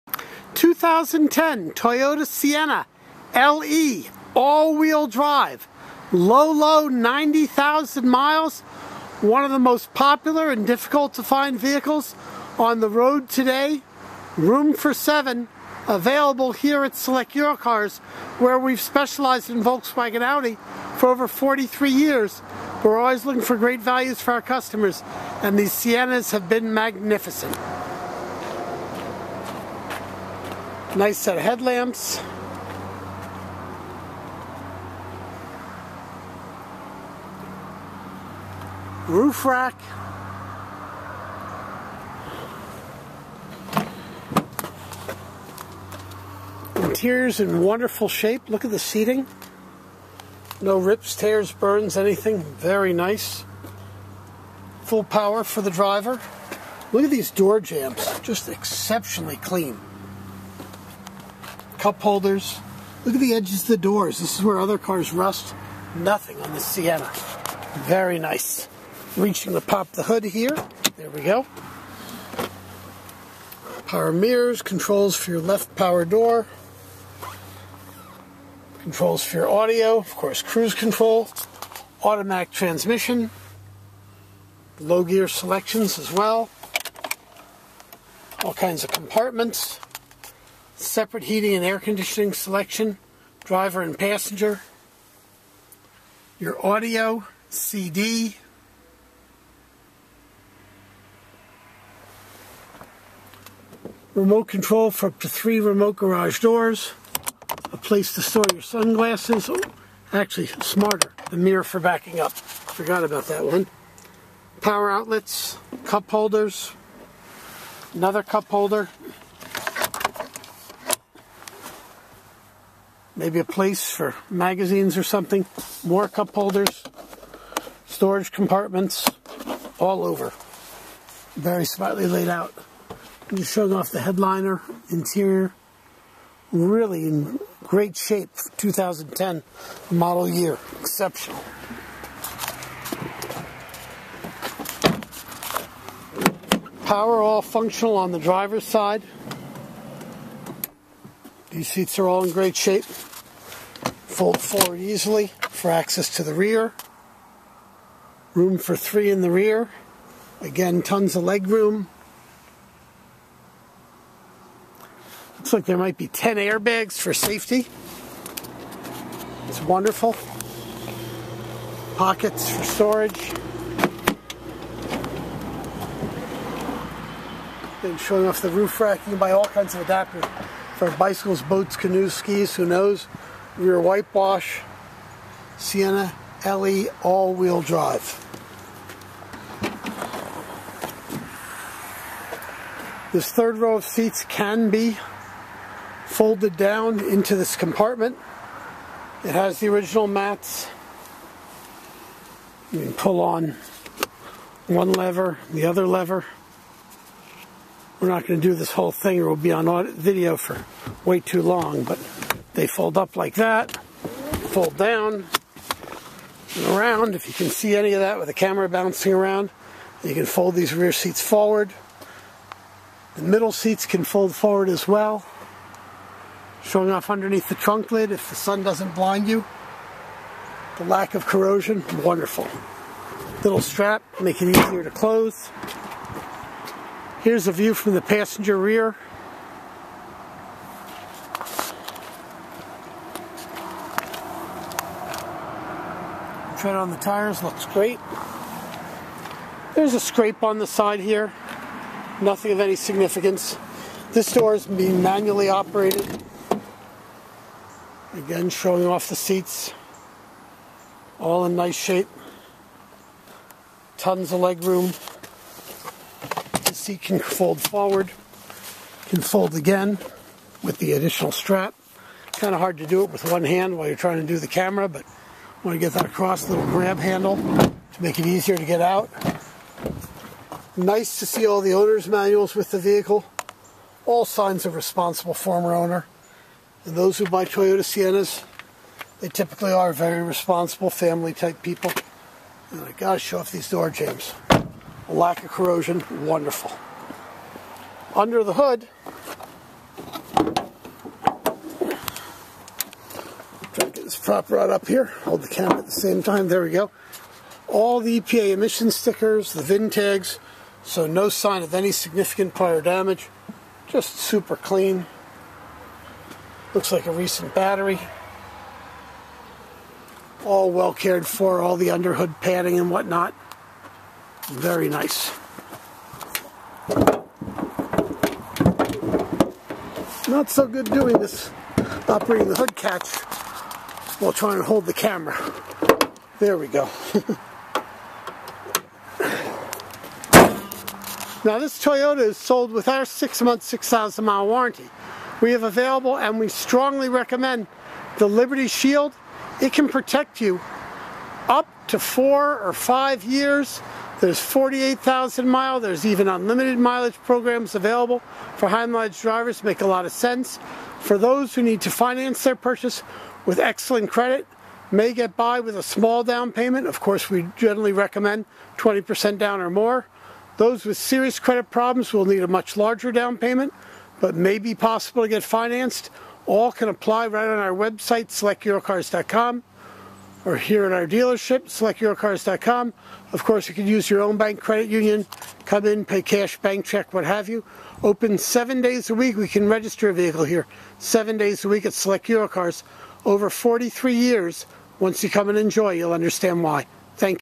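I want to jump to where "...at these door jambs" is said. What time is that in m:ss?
0:57.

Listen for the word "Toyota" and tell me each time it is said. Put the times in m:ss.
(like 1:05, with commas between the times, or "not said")
0:01, 4:47, 5:41.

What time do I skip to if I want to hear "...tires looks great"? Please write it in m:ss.
4:06.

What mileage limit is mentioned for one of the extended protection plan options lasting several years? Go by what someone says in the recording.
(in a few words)
48,000 miles.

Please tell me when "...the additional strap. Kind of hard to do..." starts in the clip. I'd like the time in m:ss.
4:30.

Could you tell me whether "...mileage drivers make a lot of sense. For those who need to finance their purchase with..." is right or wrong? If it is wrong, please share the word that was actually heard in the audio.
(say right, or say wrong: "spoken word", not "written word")
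right.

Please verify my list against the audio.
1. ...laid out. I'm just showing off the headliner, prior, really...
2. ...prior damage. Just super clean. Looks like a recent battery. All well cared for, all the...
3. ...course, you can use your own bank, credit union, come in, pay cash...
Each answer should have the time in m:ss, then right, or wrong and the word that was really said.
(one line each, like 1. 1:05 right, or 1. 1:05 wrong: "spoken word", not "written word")
1. 2:12 wrong: "interior", not "prior"
2. 5:12 right
3. 6:23 right.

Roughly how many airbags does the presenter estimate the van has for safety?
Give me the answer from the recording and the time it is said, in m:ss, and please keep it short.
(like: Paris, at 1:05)
10, at 2:46.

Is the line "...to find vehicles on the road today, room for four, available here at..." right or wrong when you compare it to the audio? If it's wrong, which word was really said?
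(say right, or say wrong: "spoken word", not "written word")
wrong: "seven", not "four".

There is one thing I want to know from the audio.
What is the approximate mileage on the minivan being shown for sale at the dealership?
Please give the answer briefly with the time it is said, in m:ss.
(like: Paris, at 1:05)
90,000 miles, at 0:06.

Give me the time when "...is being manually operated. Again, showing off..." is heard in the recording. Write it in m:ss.
4:14.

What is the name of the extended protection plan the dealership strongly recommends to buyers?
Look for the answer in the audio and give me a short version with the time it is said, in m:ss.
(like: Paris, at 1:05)
Liberty Shield, at 5:48.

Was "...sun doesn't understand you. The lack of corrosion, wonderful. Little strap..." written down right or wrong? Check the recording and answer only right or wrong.
wrong.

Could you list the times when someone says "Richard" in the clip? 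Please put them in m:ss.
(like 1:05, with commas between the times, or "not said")
not said.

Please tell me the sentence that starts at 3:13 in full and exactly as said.
This third row of seats can be folded down into this compartment.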